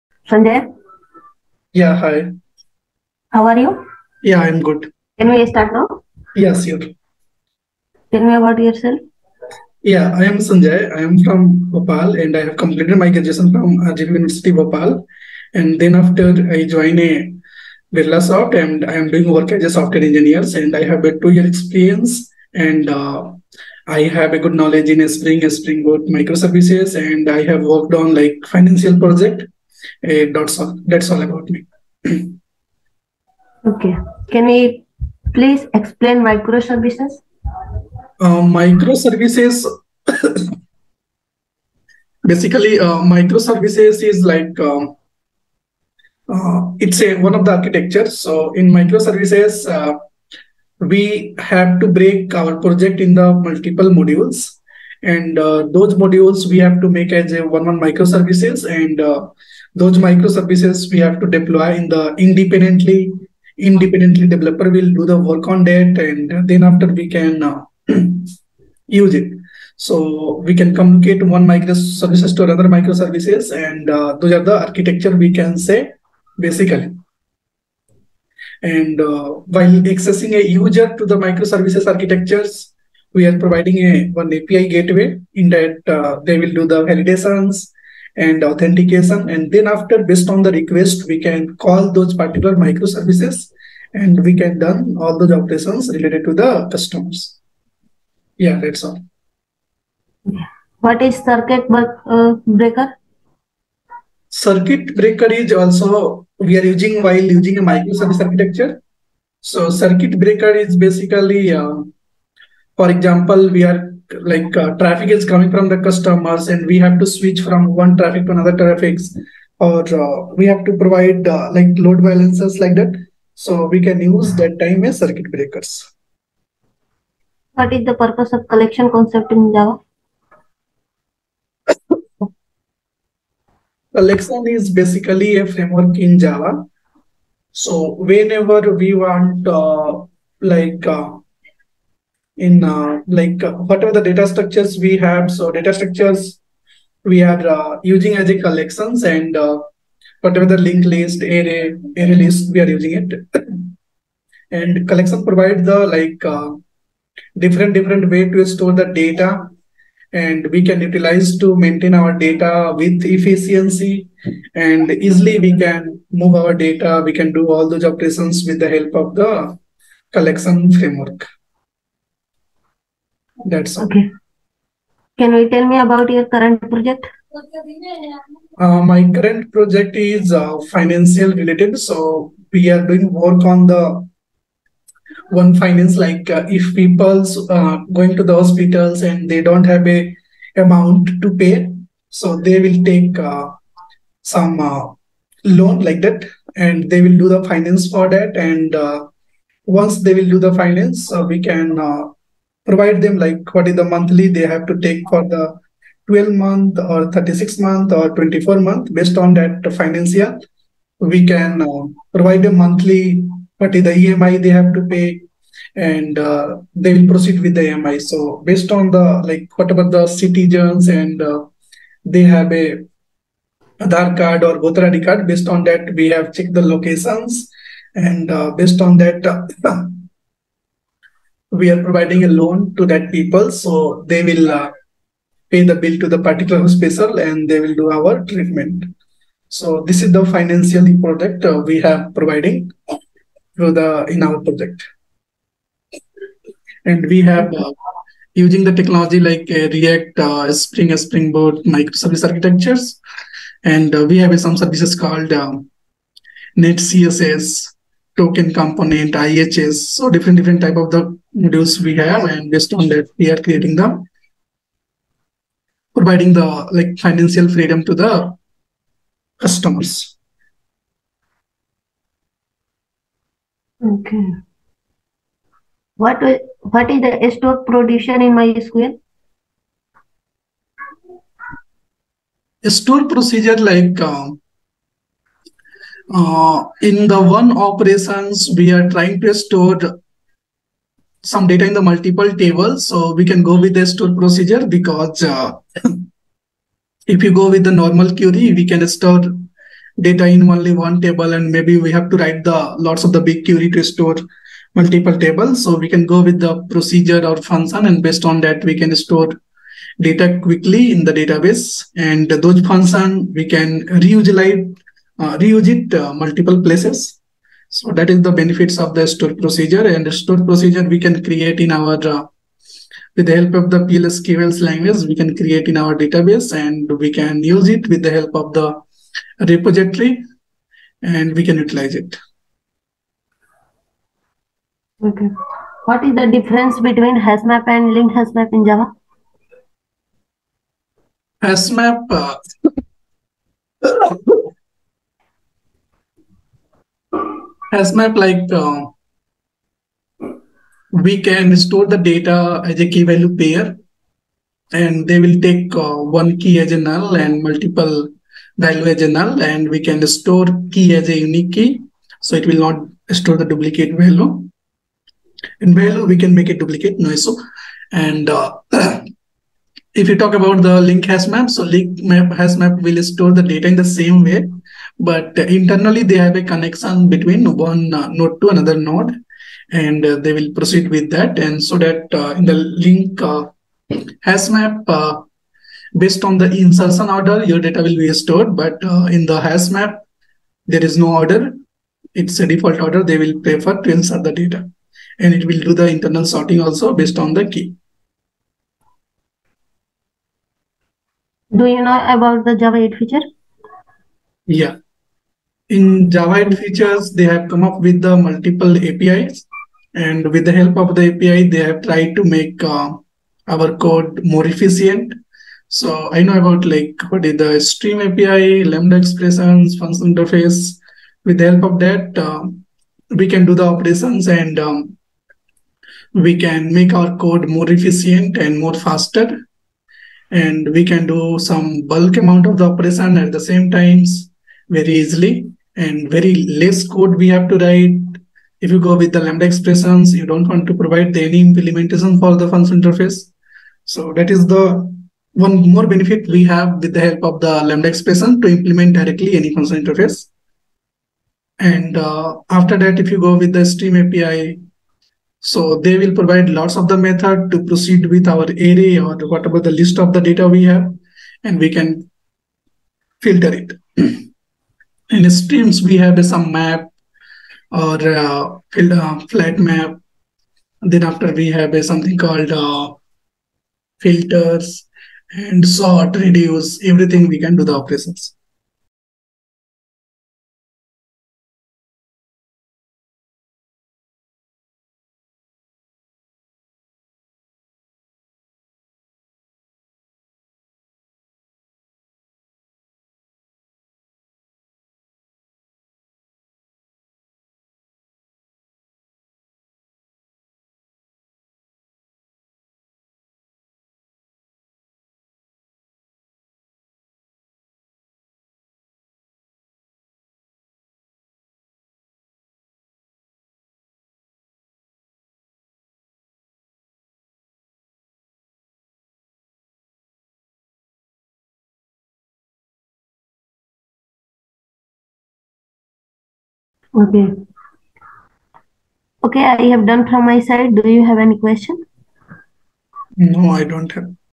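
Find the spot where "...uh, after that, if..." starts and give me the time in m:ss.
7:31.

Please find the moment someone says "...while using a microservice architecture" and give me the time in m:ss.
1:47.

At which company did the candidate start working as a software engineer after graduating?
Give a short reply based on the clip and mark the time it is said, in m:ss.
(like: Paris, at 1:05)
Birlasoft, at 0:17.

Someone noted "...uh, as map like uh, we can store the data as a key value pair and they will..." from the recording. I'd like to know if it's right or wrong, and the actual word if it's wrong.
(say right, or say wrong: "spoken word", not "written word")
right.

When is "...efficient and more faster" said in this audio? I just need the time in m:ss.
7:07.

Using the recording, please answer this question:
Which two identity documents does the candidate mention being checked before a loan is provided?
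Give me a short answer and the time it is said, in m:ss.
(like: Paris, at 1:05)
Aadhaar card or voter ID, at 3:43.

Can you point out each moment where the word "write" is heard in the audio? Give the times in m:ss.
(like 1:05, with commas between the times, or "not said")
5:02, 7:17.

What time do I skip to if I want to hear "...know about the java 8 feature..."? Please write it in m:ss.
6:41.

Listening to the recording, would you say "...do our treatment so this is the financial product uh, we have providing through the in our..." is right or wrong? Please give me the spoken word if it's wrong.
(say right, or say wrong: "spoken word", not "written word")
right.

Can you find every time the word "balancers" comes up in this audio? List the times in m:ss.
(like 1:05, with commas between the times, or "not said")
2:02.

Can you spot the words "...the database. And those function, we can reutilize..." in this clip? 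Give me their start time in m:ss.
5:11.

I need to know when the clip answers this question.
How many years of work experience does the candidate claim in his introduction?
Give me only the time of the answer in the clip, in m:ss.
0:21.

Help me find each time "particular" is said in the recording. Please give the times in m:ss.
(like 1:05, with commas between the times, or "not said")
1:32, 3:56.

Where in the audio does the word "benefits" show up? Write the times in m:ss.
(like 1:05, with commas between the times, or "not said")
5:18, 7:25.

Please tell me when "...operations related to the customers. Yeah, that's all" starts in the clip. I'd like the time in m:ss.
1:35.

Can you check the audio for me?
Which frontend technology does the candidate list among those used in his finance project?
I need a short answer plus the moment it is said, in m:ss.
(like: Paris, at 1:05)
React, at 4:09.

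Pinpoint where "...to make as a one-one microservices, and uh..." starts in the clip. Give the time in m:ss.
0:56.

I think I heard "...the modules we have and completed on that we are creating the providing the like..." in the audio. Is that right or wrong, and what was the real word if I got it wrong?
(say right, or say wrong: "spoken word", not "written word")
wrong: "based", not "completed".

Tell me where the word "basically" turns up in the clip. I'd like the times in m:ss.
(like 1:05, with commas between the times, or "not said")
0:42, 1:16, 1:50, 2:14.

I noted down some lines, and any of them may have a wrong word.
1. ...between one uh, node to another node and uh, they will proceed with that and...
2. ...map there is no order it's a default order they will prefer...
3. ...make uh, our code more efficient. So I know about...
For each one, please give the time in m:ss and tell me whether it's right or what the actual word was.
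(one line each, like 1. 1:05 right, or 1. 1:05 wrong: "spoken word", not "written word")
1. 6:17 right
2. 6:29 right
3. 6:52 right.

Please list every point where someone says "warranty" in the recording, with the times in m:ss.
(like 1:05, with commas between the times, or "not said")
not said.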